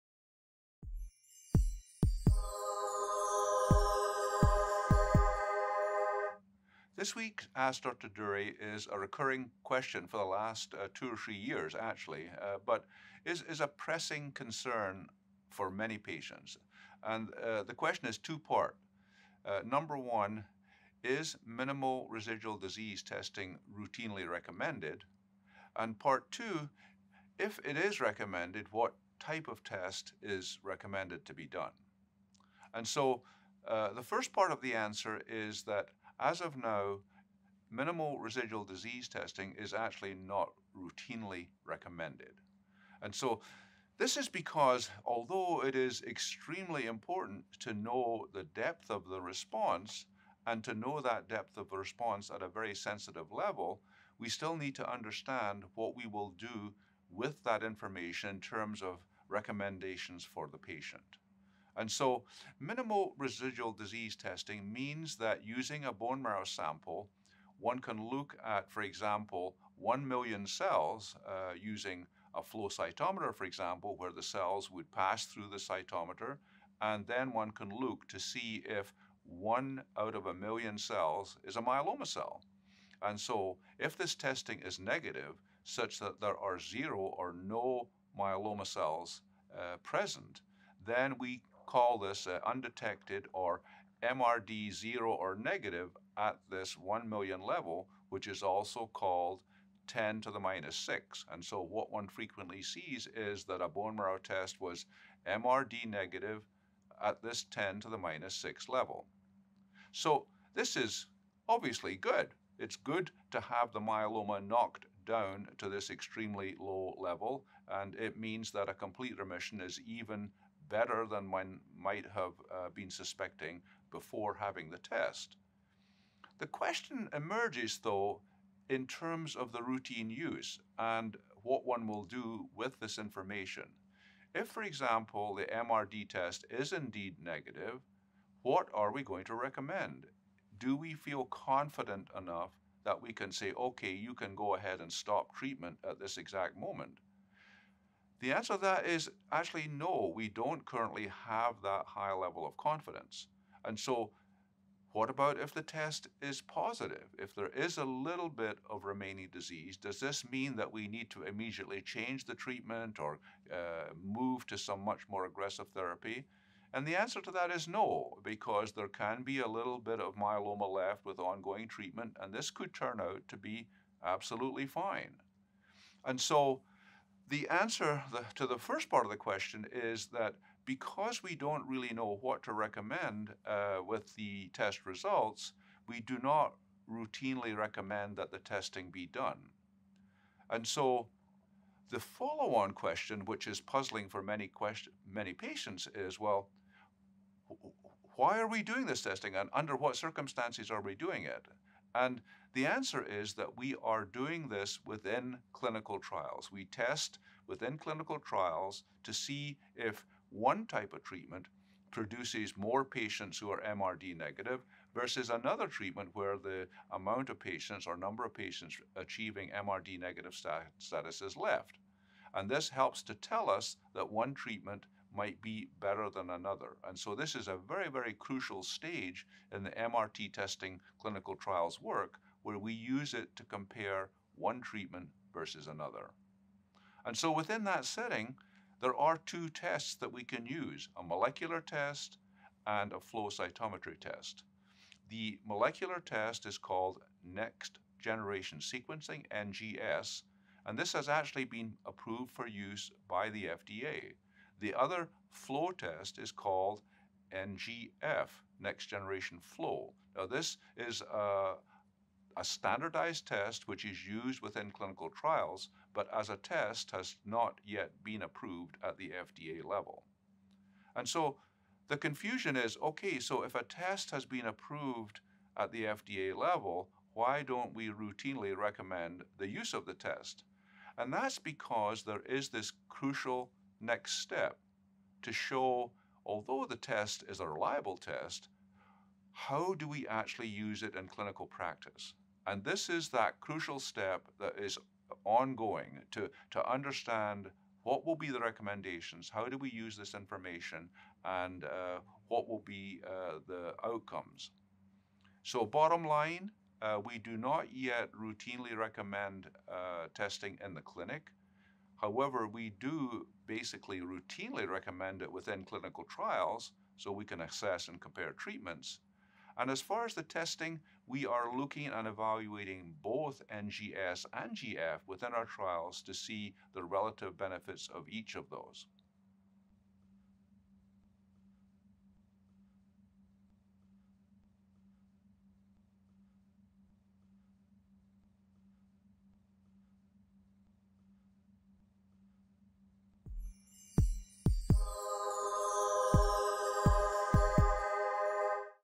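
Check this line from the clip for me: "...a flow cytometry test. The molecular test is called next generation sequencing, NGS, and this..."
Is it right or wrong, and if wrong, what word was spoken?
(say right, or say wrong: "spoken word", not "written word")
right.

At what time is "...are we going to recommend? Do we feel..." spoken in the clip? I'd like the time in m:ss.
2:18.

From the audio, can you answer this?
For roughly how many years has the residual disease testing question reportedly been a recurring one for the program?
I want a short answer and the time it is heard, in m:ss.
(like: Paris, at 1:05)
2 or 3 years, at 0:10.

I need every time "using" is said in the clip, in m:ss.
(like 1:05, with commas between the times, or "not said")
1:05, 1:11.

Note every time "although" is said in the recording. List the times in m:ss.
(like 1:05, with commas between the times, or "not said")
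0:45, 4:46.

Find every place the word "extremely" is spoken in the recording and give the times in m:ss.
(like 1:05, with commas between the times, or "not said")
0:46, 1:55.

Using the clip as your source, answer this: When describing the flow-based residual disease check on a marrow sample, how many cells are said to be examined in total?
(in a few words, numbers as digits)
1 million.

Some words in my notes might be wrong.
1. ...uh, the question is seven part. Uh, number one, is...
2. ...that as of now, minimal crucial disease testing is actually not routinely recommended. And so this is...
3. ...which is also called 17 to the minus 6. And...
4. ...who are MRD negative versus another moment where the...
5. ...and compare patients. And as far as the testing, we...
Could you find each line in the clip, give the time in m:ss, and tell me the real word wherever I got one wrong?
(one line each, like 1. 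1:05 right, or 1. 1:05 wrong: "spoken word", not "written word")
1. 0:17 wrong: "two", not "seven"
2. 0:35 wrong: "residual", not "crucial"
3. 1:38 wrong: "10", not "17"
4. 3:33 wrong: "treatment", not "moment"
5. 5:17 wrong: "treatments", not "patients".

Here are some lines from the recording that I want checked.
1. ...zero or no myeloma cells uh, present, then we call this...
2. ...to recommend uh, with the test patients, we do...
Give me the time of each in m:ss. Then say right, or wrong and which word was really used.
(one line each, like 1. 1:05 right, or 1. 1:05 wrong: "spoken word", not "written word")
1. 1:26 right
2. 3:02 wrong: "results", not "patients".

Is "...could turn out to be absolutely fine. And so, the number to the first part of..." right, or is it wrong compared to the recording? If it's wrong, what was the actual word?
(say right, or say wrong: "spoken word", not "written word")
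wrong: "answer", not "number".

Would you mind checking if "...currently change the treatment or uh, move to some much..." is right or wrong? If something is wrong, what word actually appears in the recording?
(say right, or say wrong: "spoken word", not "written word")
wrong: "immediately", not "currently".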